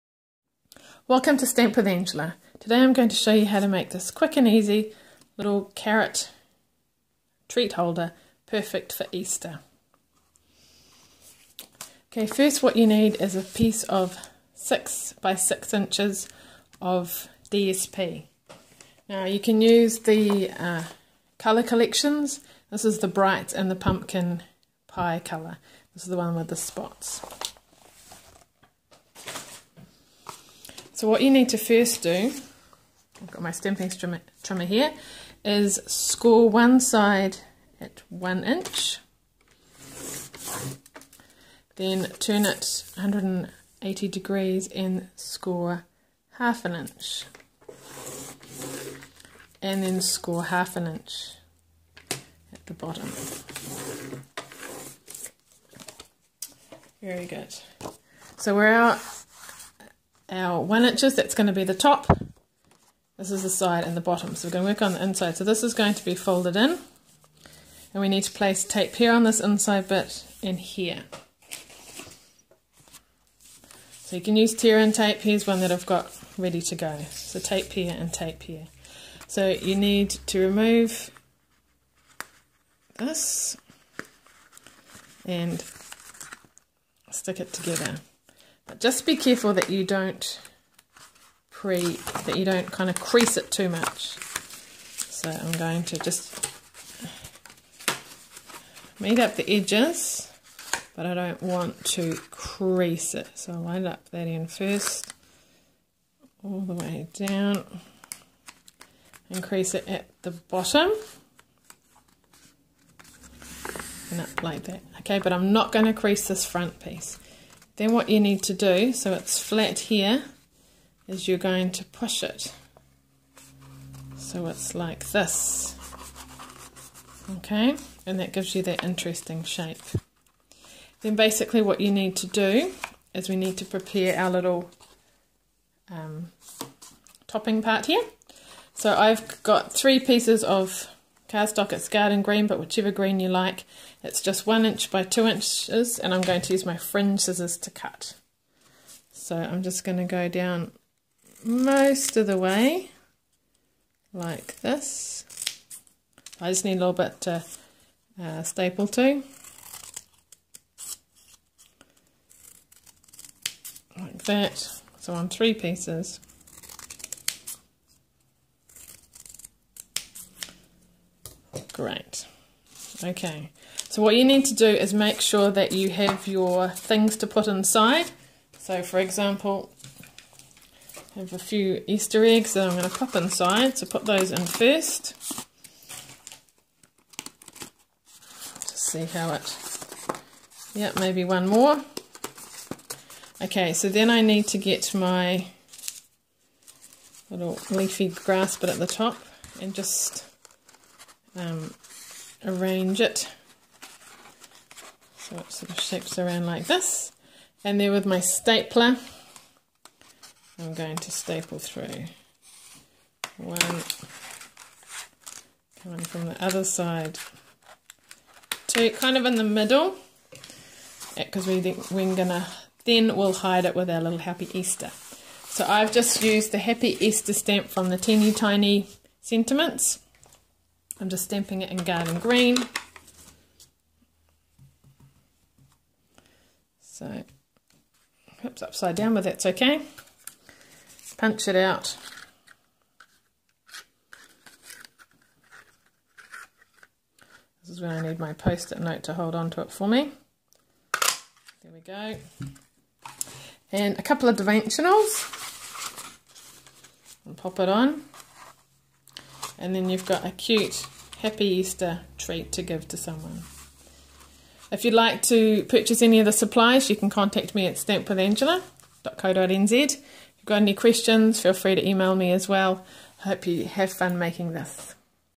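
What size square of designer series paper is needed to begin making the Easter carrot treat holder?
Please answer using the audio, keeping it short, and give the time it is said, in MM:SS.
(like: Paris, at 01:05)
6 by 6 inches, at 00:14.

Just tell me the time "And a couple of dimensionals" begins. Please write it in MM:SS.
04:13.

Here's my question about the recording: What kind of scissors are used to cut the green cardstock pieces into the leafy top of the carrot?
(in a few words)
fringe scissors.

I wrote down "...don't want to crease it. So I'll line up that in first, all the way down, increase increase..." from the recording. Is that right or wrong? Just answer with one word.
wrong.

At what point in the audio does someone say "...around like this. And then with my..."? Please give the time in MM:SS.
03:26.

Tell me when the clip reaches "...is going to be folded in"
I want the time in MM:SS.
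01:05.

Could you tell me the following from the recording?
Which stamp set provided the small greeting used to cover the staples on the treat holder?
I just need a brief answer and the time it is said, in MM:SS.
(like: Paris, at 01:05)
teeny tiny sentiments, at 03:47.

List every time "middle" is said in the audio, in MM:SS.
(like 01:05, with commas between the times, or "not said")
03:39.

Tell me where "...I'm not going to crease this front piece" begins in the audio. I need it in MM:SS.
01:55.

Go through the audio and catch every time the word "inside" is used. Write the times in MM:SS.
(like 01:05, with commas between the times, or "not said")
01:05, 01:09, 02:57, 03:03.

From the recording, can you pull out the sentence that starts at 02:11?
Then basically what you need to do is we need to prepare our little um, topping part here.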